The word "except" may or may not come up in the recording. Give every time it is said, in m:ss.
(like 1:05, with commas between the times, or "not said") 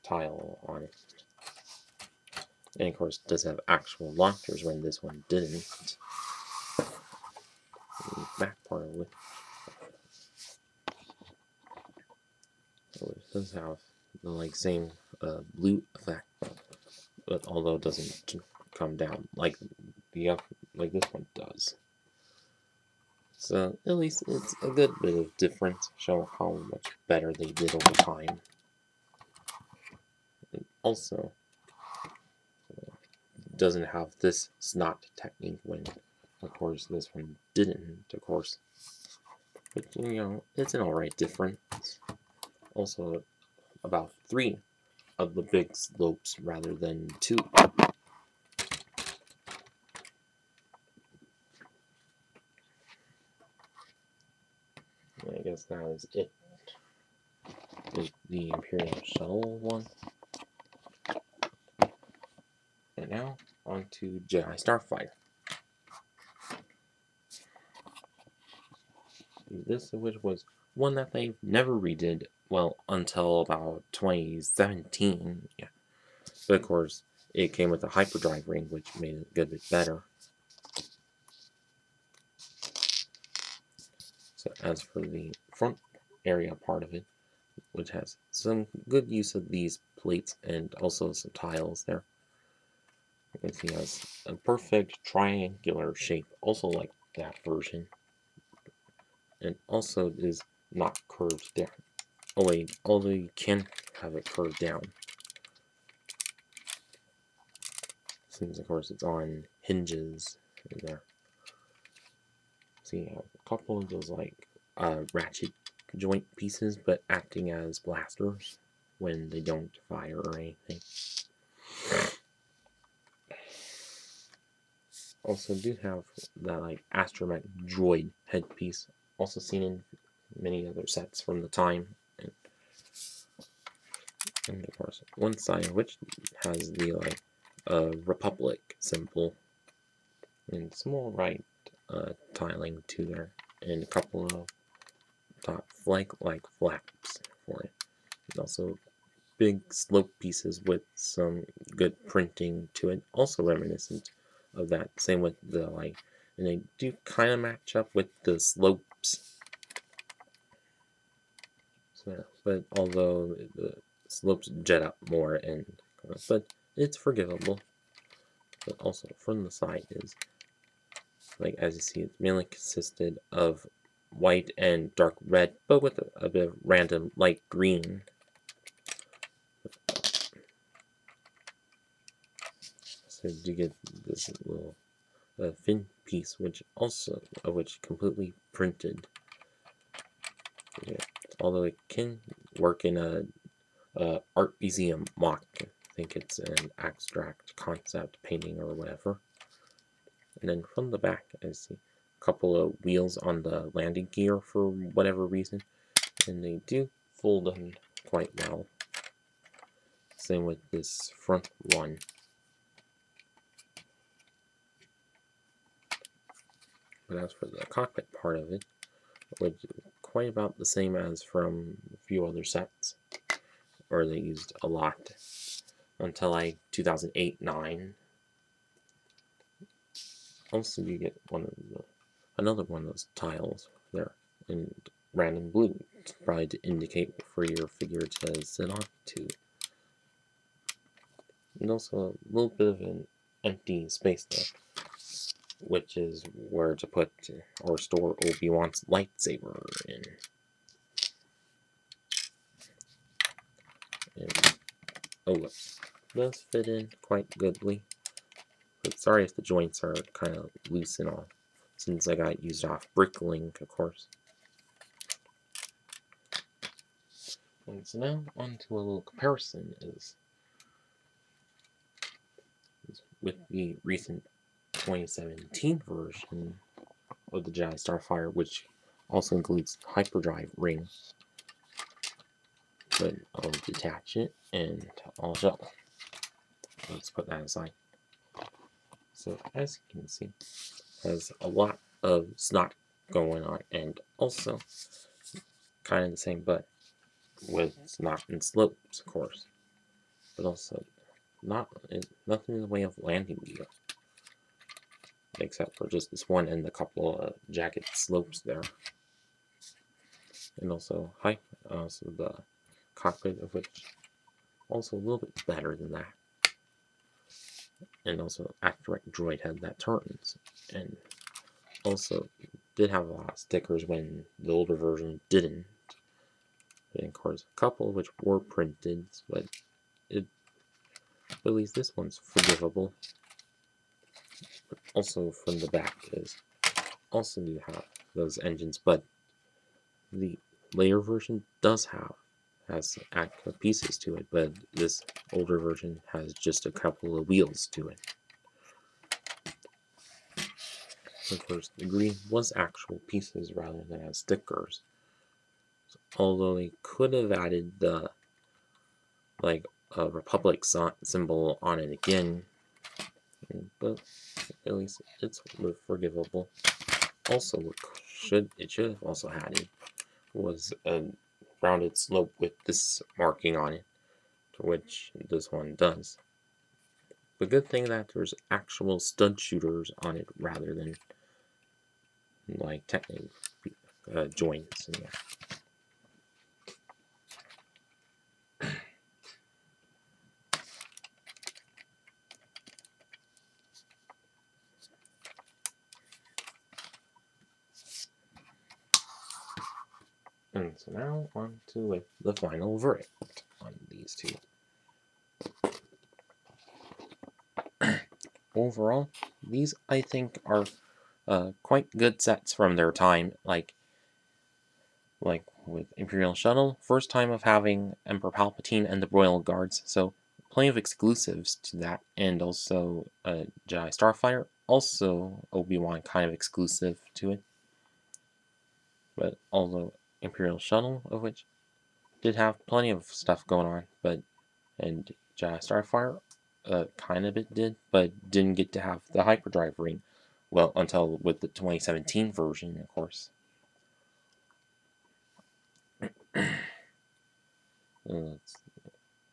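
5:05.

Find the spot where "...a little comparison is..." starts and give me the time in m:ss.
4:28.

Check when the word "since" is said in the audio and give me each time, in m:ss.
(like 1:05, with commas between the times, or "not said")
1:48, 4:21.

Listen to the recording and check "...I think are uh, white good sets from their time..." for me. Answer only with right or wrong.
wrong.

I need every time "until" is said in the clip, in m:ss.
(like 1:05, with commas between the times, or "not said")
1:12, 3:45, 7:20.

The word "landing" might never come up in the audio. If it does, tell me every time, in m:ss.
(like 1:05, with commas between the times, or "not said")
3:23, 5:02.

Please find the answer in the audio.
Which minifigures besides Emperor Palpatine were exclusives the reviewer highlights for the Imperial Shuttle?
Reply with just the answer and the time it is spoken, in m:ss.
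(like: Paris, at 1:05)
Royal Guards, at 6:59.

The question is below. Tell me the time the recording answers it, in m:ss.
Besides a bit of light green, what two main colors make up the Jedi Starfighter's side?
2:54.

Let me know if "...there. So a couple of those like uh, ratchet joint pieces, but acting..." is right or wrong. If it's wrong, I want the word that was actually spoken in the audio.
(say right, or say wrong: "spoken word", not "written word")
right.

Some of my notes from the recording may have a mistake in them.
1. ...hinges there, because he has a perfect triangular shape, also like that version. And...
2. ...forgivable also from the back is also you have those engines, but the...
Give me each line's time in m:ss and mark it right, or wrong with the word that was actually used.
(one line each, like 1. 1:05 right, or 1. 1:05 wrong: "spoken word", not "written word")
1. 1:31 wrong: "tiles", not "hinges"
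2. 5:32 right.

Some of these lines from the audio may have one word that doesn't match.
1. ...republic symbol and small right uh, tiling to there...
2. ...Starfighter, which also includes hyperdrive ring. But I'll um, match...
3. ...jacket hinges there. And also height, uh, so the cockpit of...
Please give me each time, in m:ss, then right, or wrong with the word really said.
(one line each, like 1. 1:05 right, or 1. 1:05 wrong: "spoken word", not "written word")
1. 2:18 right
2. 4:37 wrong: "detach", not "match"
3. 5:07 wrong: "slopes", not "hinges".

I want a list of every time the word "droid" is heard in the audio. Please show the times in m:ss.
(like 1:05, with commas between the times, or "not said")
2:07, 5:19.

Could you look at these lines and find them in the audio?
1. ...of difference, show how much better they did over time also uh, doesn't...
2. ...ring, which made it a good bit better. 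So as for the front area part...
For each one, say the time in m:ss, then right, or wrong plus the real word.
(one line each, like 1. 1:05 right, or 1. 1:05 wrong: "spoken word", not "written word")
1. 0:25 right
2. 1:18 right.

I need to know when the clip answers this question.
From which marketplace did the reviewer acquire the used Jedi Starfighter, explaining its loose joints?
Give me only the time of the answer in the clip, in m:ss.
4:22.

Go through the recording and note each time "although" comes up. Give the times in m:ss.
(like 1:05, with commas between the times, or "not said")
0:17, 1:42, 2:42, 3:11, 5:56.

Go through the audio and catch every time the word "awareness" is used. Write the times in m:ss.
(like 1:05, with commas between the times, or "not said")
not said.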